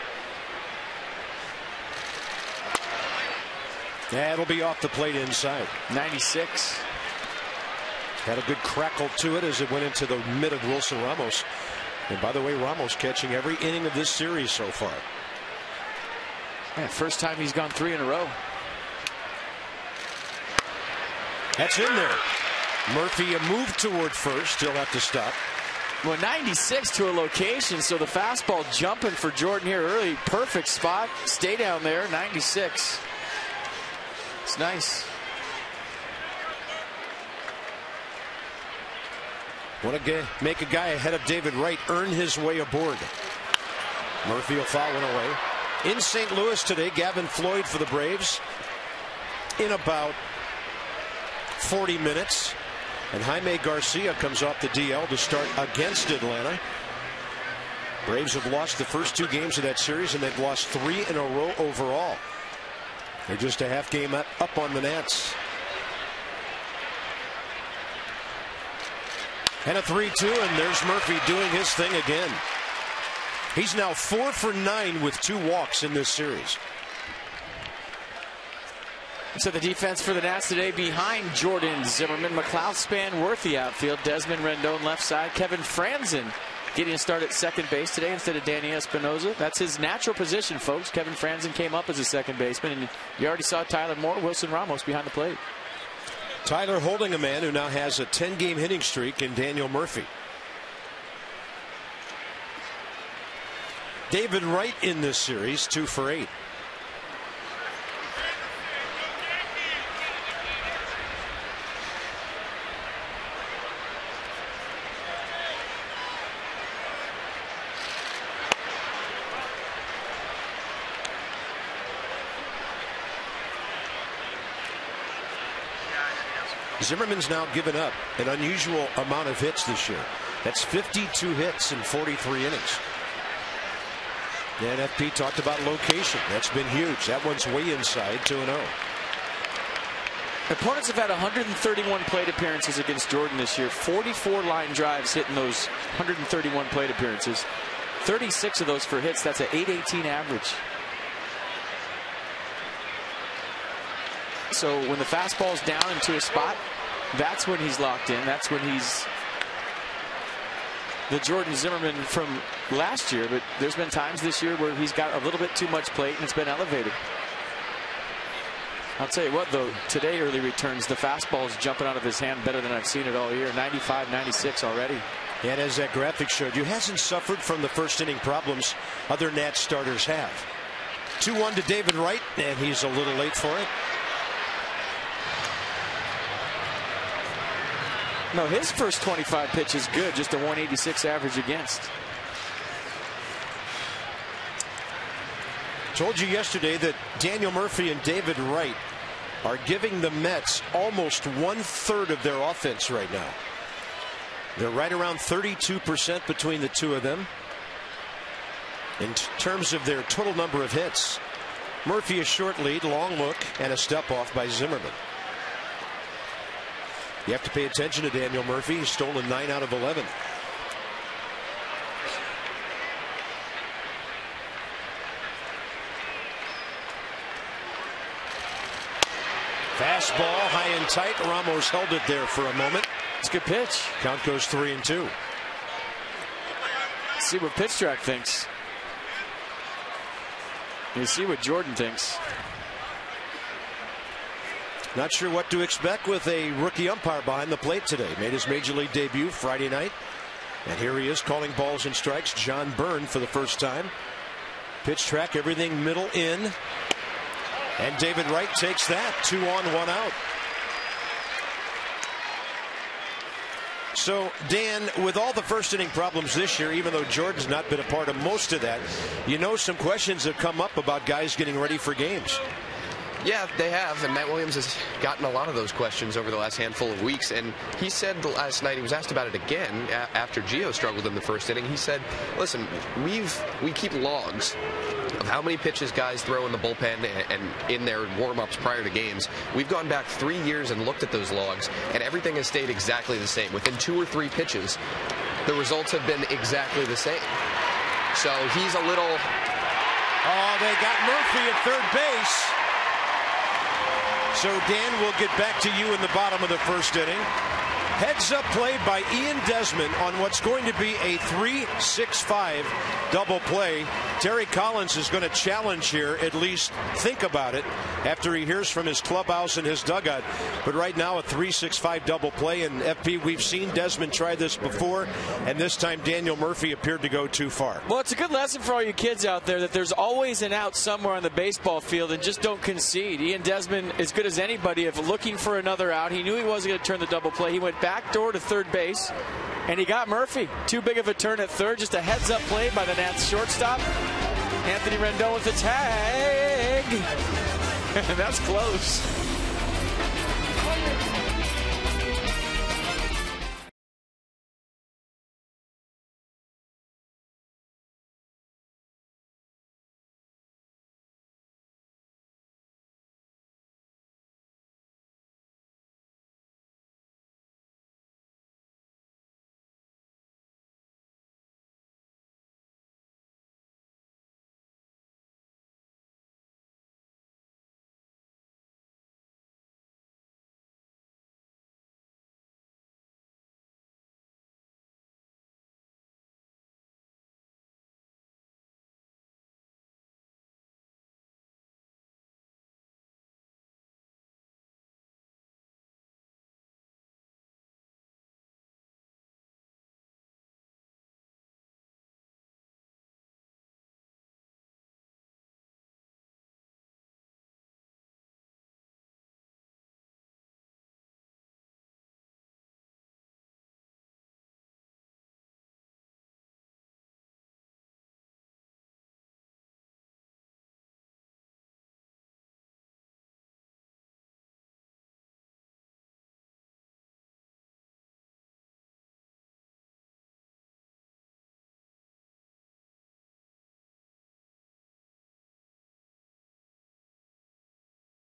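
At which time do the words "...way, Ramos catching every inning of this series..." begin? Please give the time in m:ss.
0:12.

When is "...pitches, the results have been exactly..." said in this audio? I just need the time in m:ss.
4:54.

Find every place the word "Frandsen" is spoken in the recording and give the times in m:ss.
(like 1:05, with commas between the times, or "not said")
1:25, 1:31.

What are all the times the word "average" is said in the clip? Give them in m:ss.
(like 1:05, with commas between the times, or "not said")
2:30, 3:11.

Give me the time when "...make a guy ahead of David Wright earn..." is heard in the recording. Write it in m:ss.
0:40.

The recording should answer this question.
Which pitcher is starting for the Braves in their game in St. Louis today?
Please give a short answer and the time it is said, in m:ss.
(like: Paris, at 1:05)
Gavin Floyd, at 0:46.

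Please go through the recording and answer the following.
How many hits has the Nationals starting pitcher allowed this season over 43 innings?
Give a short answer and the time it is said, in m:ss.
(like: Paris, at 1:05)
52, at 2:10.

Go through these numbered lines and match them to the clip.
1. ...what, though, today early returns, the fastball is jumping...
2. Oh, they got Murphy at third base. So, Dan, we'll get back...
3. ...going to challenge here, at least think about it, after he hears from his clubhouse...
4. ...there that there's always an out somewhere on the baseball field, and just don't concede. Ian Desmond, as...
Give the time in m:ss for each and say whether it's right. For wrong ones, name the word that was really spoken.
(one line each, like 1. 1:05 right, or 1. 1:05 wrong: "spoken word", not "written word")
1. 2:49 right
2. 5:00 right
3. 5:15 right
4. 5:29 right.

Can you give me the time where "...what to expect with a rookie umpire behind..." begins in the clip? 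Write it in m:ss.
4:05.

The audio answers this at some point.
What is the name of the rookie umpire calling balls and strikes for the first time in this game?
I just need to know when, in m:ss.
4:12.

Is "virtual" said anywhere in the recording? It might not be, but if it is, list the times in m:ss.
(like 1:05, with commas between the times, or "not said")
not said.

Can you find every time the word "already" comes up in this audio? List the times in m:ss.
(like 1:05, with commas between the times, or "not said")
1:33, 2:54.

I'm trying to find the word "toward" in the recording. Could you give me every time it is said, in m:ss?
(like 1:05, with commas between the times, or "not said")
0:23.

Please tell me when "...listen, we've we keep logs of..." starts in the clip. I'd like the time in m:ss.
4:42.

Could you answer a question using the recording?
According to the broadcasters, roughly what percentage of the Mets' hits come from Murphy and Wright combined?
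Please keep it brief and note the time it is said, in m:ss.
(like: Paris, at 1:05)
32%, at 3:25.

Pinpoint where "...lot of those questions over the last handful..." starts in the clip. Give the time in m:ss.
4:35.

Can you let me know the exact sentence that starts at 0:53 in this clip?
And Jaime Garcia comes off the DL to start against Atlanta.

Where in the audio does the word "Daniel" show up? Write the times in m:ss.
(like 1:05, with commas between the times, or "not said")
1:39, 3:17, 3:38, 5:26.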